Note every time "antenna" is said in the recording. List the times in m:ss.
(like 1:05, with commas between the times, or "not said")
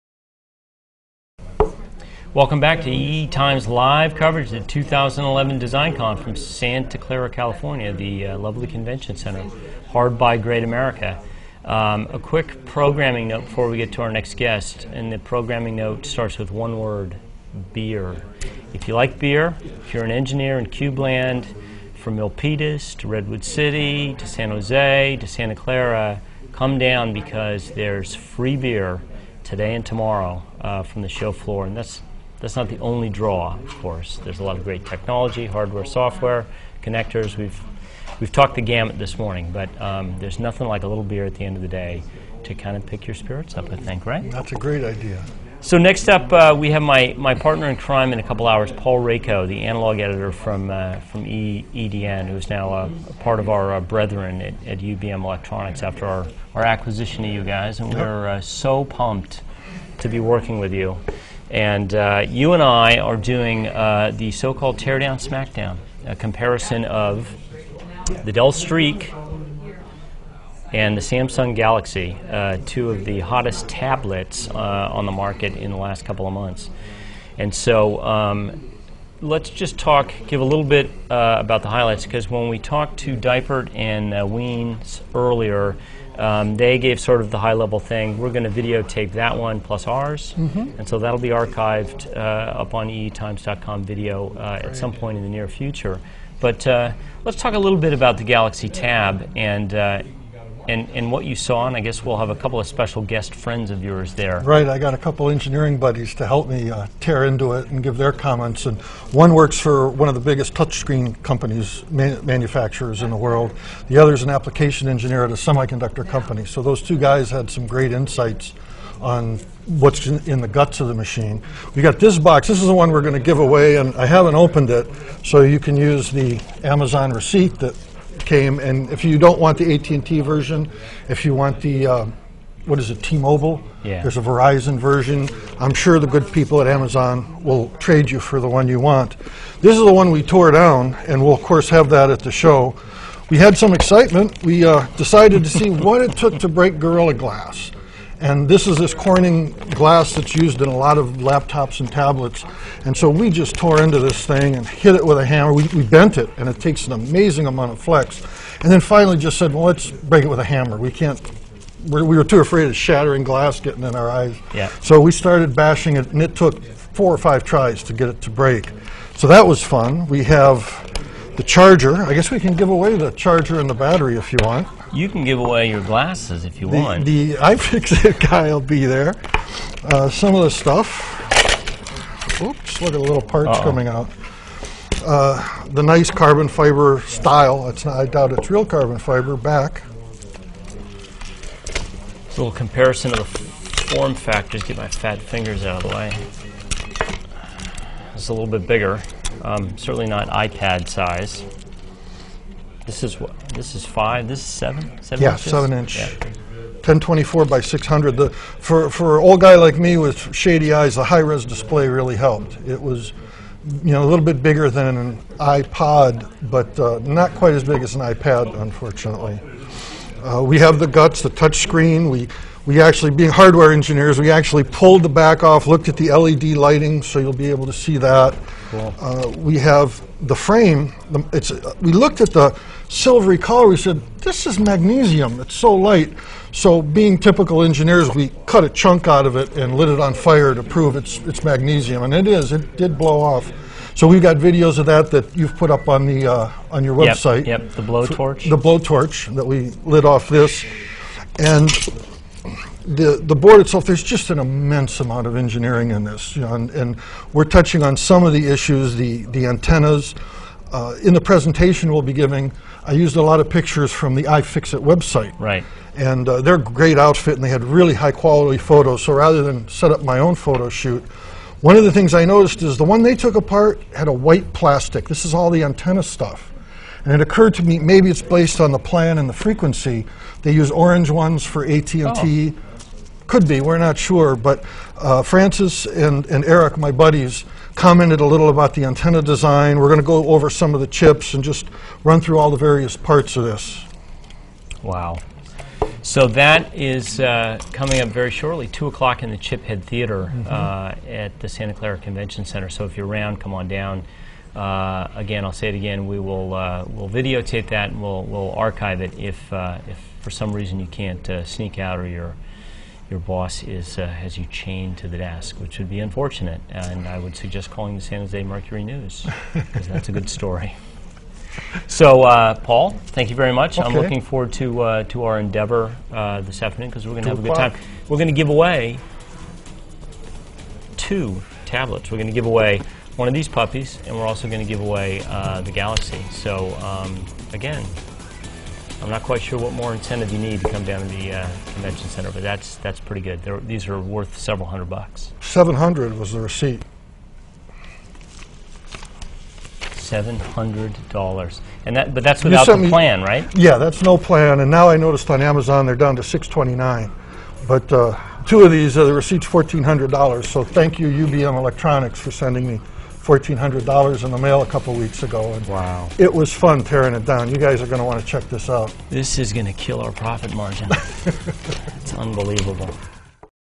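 4:19, 4:35, 4:48.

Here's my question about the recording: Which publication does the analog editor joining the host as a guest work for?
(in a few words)
EDN.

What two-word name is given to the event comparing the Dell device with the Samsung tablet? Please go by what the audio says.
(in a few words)
Teardown Smackdown.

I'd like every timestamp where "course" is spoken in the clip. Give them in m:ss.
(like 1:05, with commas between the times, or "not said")
0:33, 2:21.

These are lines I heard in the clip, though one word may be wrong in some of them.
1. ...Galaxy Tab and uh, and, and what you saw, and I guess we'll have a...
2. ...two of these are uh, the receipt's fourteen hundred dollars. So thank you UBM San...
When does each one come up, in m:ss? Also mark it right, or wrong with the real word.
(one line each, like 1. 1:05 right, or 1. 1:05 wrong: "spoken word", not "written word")
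1. 1:38 right
2. 5:58 wrong: "Electronics", not "San".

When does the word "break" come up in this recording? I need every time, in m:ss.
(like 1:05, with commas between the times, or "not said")
2:26, 2:39, 2:48.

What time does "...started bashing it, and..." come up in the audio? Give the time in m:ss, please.
2:45.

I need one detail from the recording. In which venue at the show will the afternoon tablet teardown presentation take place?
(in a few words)
Chiphead Theater.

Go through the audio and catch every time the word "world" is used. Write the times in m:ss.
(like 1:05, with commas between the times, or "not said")
1:53.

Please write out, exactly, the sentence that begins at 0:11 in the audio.
Um, a quick programming note before we get to our next guest, and the programming note starts with one word beer.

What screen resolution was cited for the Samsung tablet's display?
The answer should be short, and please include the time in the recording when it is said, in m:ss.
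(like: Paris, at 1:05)
1024 by 600, at 3:26.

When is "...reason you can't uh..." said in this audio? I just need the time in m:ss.
5:10.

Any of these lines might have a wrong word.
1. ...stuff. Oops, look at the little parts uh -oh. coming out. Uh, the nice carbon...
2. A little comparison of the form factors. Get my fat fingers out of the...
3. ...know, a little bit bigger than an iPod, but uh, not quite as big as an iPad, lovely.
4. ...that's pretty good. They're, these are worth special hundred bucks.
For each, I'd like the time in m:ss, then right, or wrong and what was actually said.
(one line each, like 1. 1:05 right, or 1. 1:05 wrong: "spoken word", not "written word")
1. 3:00 right
2. 3:12 right
3. 3:33 wrong: "unfortunately", not "lovely"
4. 5:42 wrong: "several", not "special".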